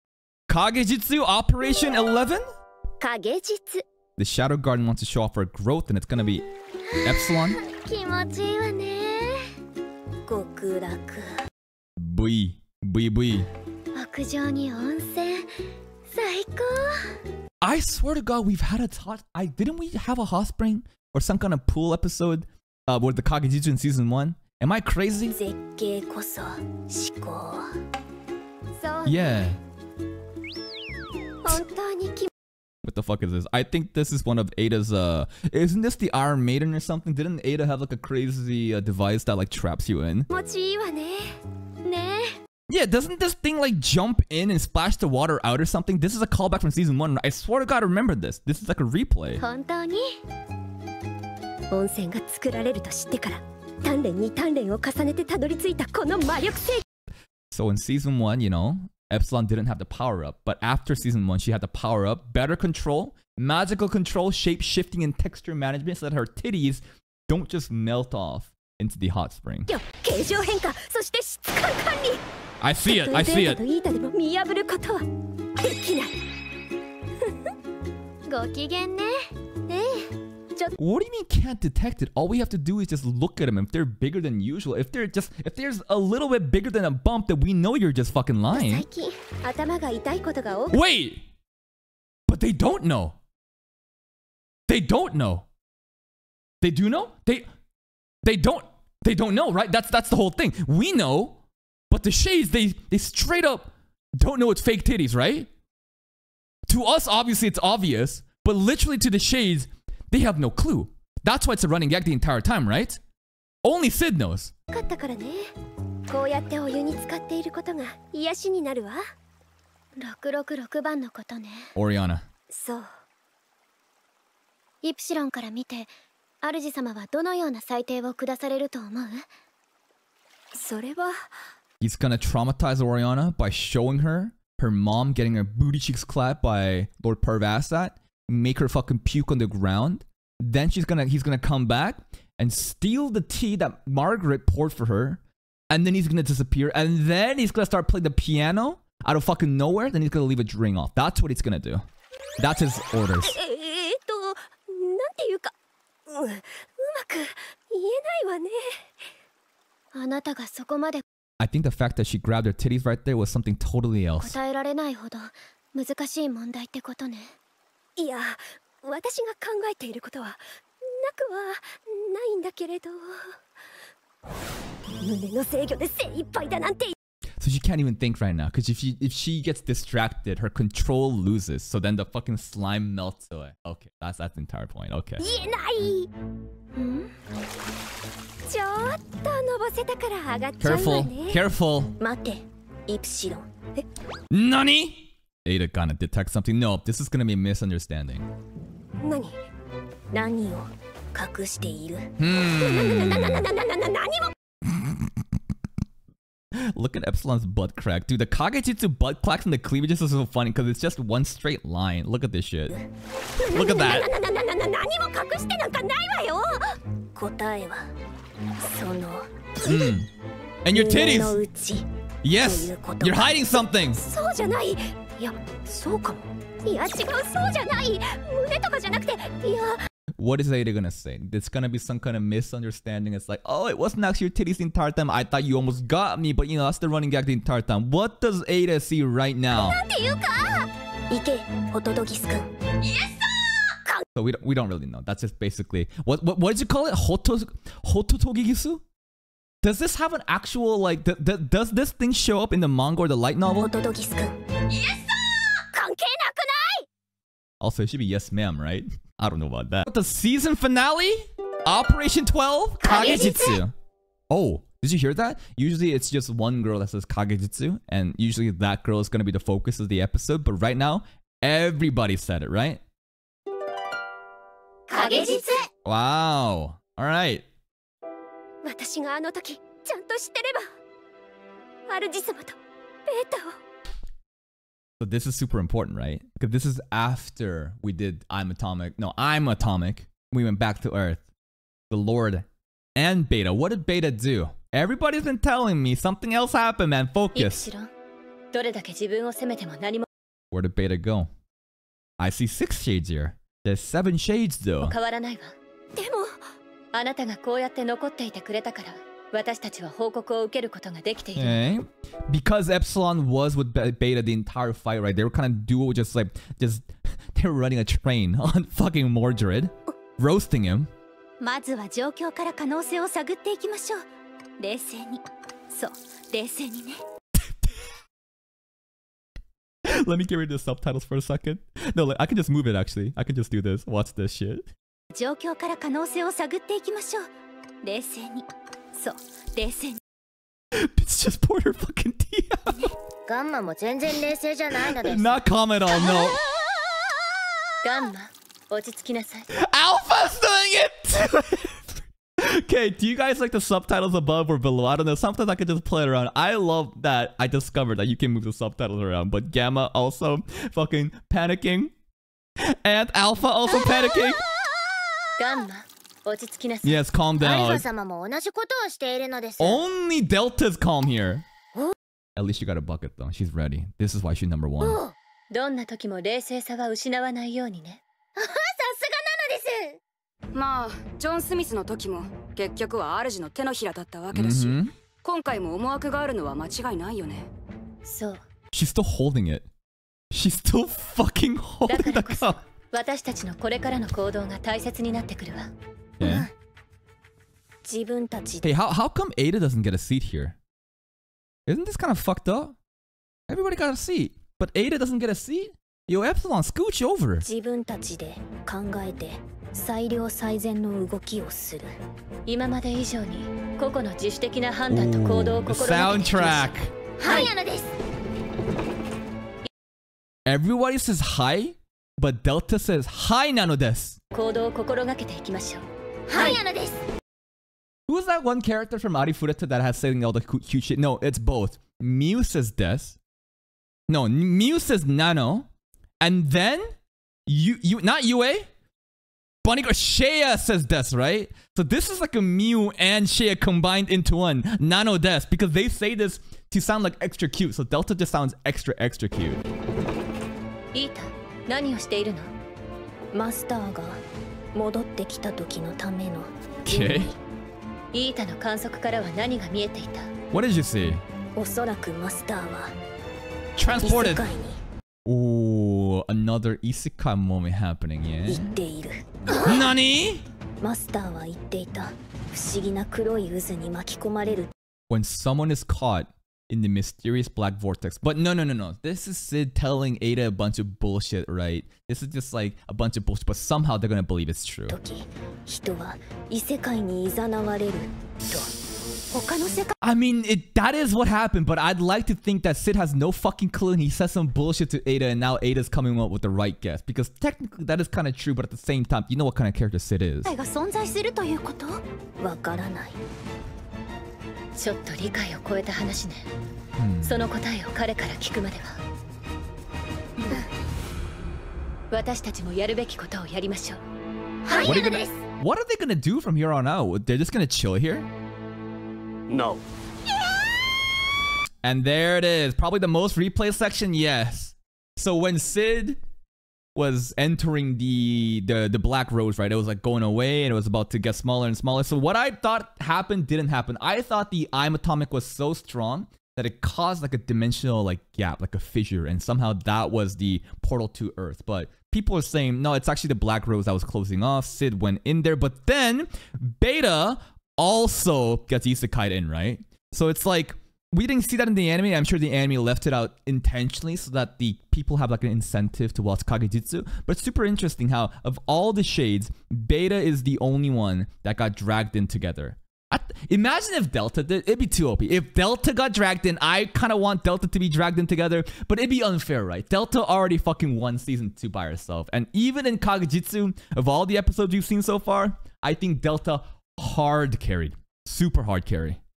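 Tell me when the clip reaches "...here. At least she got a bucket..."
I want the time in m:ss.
6:11.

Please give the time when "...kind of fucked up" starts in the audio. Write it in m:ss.
6:41.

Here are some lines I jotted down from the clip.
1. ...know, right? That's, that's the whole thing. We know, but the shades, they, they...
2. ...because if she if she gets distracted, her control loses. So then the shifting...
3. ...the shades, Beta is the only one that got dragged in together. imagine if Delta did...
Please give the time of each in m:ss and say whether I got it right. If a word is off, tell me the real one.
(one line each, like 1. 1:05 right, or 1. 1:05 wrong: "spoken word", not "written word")
1. 1:39 right
2. 2:58 wrong: "fucking", not "shifting"
3. 9:18 right.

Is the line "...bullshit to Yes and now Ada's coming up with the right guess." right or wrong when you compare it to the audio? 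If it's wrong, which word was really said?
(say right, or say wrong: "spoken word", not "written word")
wrong: "Ada", not "Yes".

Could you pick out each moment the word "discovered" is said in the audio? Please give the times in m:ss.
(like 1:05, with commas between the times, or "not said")
5:57.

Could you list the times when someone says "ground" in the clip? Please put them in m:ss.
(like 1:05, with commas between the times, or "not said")
2:19.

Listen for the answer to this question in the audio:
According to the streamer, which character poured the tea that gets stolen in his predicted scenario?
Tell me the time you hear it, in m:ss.
2:23.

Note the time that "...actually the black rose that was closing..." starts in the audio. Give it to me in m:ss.
9:03.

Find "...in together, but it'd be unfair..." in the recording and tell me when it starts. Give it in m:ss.
9:28.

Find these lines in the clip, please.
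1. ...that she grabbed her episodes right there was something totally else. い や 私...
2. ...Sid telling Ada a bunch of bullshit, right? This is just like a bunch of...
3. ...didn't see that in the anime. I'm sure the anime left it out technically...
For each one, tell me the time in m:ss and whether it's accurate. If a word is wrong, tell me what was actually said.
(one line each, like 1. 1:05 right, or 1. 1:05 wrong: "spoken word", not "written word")
1. 2:41 wrong: "titties", not "episodes"
2. 7:59 right
3. 9:11 wrong: "intentionally", not "technically".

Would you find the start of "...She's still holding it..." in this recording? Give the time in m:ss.
6:28.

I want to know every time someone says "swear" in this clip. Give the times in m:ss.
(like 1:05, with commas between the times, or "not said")
0:17, 0:47.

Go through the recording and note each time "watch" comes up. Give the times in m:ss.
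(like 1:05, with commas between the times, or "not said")
5:33, 9:16.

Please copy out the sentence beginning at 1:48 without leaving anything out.
But literally to the shades, they have no clue.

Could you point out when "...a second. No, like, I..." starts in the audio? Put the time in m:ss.
5:31.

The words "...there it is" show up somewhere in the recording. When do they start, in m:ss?
8:42.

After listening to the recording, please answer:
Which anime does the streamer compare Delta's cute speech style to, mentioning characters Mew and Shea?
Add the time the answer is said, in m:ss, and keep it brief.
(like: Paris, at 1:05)
Arifureta, at 7:09.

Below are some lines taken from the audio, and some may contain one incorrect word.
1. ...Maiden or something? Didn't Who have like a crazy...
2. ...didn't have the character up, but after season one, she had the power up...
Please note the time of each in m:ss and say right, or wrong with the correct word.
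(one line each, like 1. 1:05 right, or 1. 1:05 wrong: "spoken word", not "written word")
1. 0:36 wrong: "Ada", not "Who"
2. 0:59 wrong: "power", not "character".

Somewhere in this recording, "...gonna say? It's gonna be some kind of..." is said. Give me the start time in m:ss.
3:50.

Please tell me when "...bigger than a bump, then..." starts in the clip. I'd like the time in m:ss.
1:26.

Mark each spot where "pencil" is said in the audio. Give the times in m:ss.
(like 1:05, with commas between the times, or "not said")
not said.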